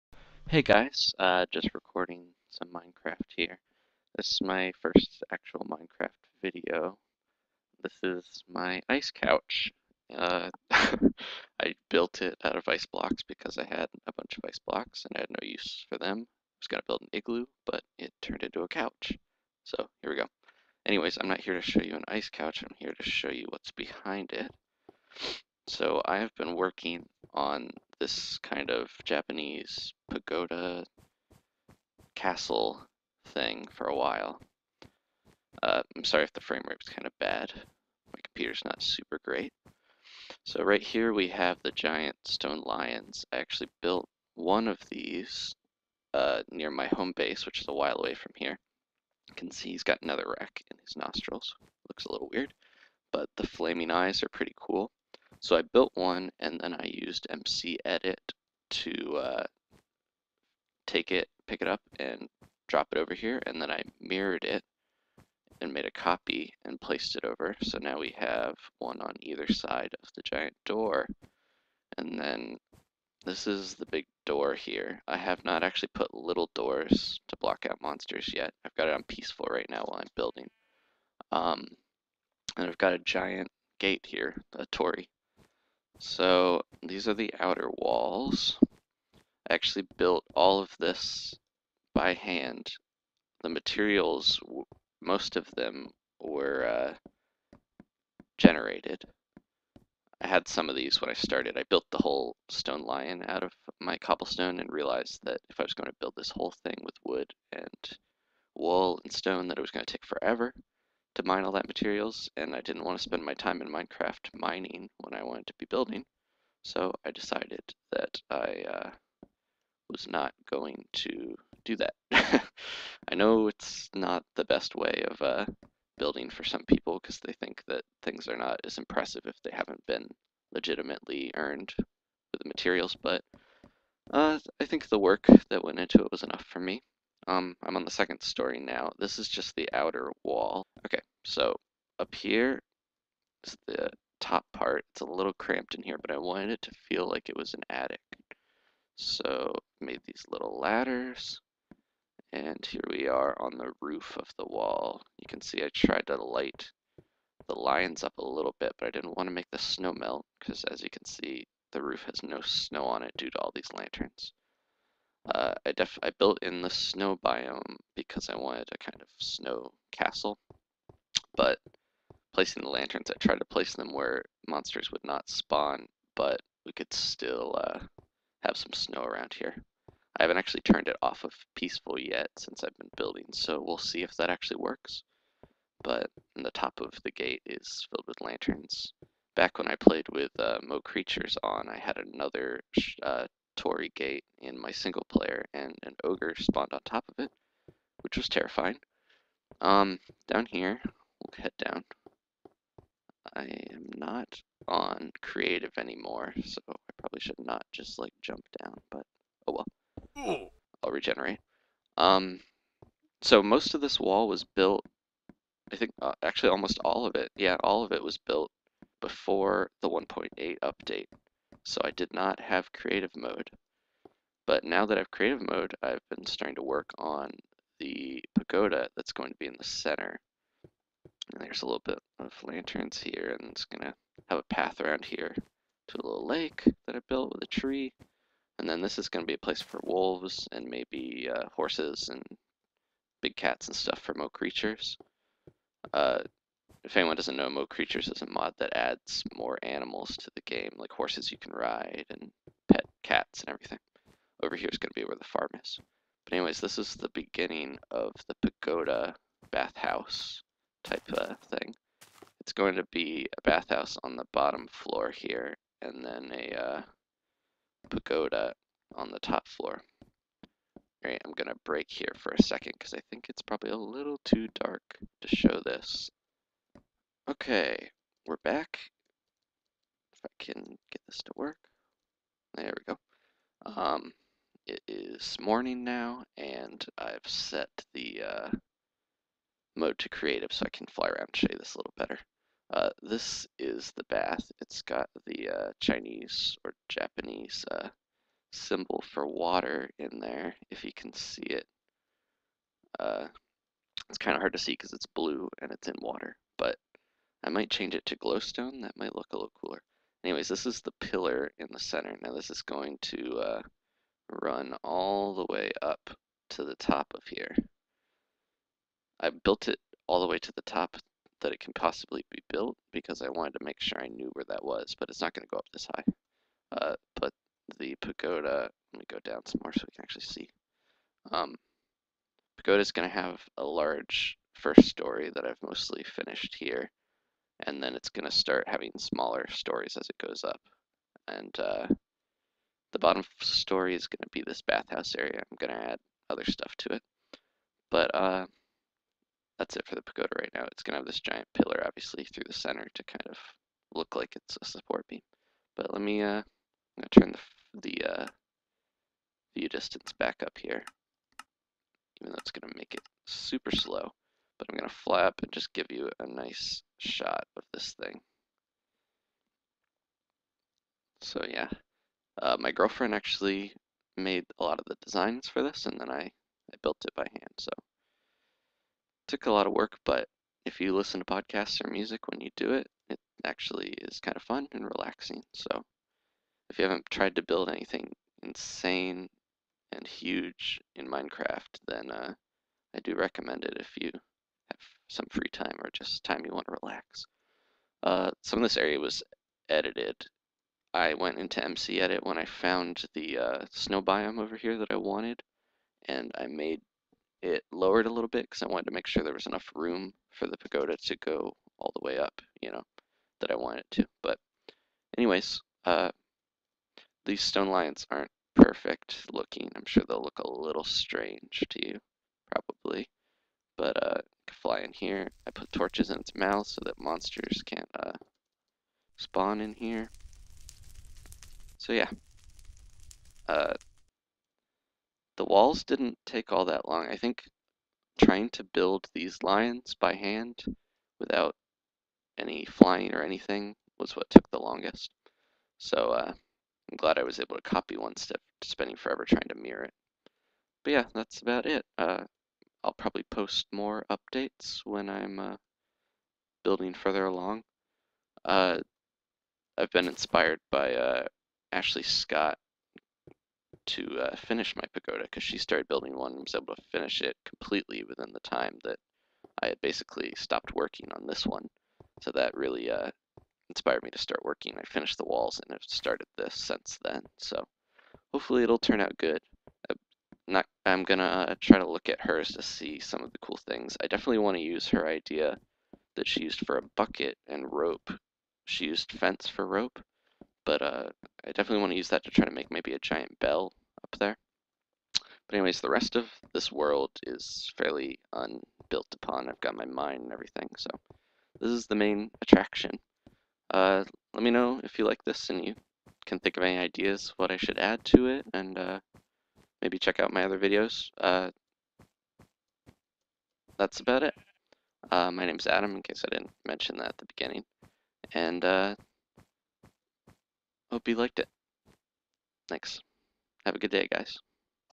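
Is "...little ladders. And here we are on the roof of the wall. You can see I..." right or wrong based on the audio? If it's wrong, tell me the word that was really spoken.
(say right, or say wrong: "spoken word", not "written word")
right.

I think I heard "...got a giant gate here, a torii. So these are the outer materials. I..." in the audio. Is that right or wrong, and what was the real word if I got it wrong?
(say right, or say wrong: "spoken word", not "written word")
wrong: "walls", not "materials".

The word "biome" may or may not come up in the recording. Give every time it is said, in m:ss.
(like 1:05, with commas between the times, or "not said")
2:47, 6:44.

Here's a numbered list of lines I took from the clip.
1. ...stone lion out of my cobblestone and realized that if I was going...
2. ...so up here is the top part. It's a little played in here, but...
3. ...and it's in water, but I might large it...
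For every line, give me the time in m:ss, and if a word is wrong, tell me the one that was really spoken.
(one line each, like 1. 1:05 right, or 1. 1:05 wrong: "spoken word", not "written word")
1. 1:42 right
2. 2:21 wrong: "cramped", not "played"
3. 5:05 wrong: "change", not "large".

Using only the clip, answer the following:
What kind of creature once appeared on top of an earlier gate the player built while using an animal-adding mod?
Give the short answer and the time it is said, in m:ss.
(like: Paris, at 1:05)
An ogre, at 3:16.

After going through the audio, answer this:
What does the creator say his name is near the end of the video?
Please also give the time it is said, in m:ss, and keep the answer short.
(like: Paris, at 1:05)
Adam, at 8:35.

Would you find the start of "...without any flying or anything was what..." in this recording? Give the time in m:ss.
7:21.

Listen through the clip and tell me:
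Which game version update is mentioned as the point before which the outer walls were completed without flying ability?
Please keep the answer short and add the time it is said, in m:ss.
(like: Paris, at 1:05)
1.8, at 3:39.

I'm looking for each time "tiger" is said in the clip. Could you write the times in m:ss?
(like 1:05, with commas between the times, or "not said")
not said.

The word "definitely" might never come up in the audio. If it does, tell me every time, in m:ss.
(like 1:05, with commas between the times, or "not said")
8:04, 8:11.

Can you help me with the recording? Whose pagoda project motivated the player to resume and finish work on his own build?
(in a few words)
Ashley Scott.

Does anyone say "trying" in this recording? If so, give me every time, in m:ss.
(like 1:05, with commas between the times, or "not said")
7:18, 7:29.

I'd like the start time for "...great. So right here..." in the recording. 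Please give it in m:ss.
0:39.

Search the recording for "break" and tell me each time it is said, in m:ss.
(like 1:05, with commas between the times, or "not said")
4:31.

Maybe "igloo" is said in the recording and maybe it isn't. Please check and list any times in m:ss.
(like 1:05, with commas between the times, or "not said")
0:17.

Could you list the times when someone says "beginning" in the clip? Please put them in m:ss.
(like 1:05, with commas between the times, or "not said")
4:17, 8:37.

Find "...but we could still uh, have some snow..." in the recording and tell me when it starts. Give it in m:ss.
2:56.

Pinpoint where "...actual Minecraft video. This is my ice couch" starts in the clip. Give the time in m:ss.
0:05.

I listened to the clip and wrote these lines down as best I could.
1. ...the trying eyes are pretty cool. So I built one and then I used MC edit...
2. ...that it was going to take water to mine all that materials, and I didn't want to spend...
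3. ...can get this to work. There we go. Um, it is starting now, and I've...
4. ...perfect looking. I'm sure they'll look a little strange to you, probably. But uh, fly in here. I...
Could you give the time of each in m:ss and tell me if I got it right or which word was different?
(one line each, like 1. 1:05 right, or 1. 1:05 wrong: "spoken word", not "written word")
1. 0:53 wrong: "flaming", not "trying"
2. 1:49 wrong: "forever", not "water"
3. 4:40 wrong: "morning", not "starting"
4. 6:58 right.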